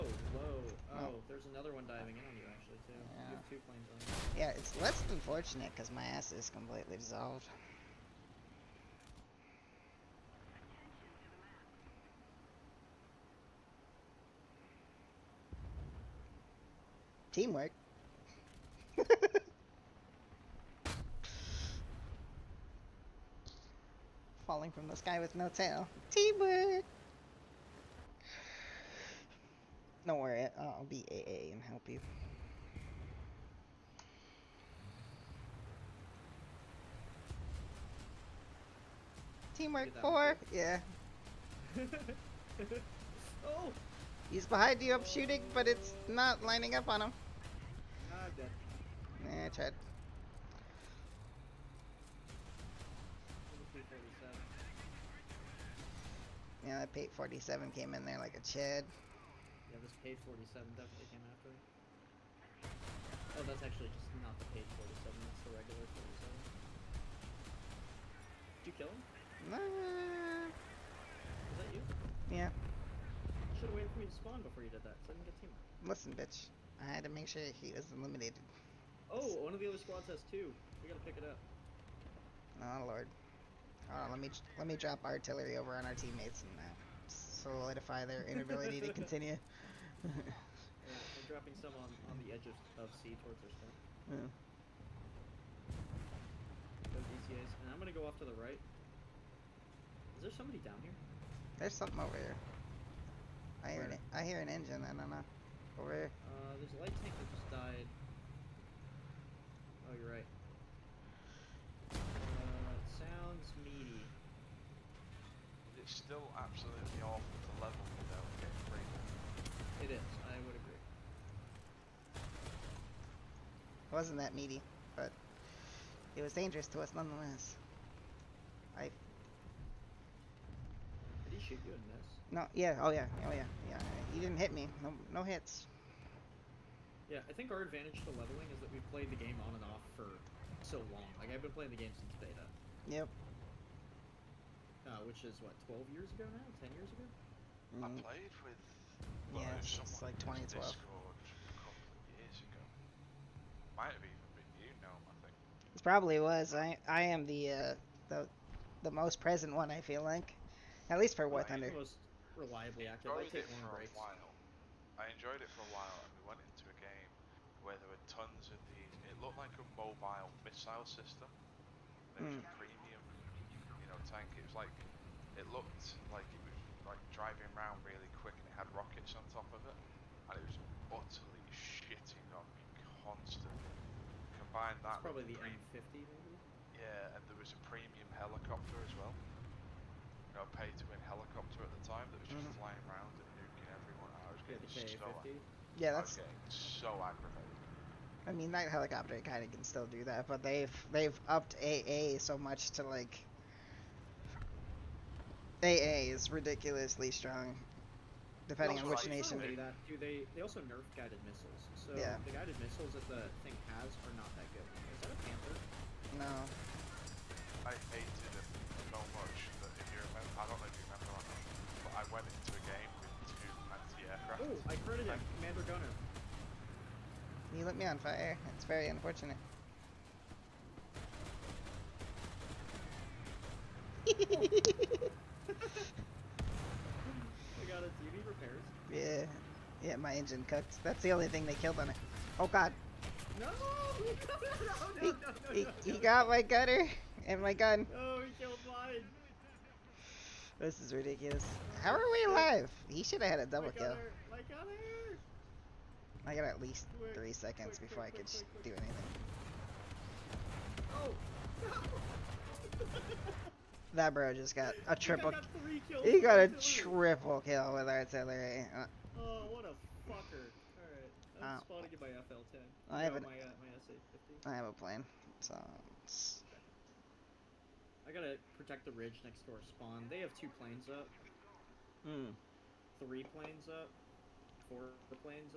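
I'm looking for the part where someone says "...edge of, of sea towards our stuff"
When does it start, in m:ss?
1:32.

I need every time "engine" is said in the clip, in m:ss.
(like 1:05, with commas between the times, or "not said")
1:44, 4:00.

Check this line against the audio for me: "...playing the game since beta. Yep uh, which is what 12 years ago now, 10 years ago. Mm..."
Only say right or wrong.
right.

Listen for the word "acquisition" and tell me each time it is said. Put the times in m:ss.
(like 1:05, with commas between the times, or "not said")
not said.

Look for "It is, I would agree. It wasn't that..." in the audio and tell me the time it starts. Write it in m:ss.
1:59.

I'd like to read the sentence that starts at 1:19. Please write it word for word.
Oh, one of the other squads has two.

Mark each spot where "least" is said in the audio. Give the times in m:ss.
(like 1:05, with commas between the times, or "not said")
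2:11, 2:41, 4:16.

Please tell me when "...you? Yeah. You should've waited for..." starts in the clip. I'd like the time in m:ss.
1:11.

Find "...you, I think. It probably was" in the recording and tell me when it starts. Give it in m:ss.
2:34.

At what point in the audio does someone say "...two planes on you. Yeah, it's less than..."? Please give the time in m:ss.
0:03.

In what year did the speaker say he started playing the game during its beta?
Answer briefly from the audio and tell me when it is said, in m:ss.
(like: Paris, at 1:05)
2012, at 2:30.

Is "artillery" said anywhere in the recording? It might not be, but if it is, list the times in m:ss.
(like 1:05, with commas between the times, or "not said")
1:25, 4:27.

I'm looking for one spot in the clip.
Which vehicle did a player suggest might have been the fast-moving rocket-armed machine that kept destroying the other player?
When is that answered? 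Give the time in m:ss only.
3:05.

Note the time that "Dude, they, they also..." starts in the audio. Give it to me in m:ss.
3:29.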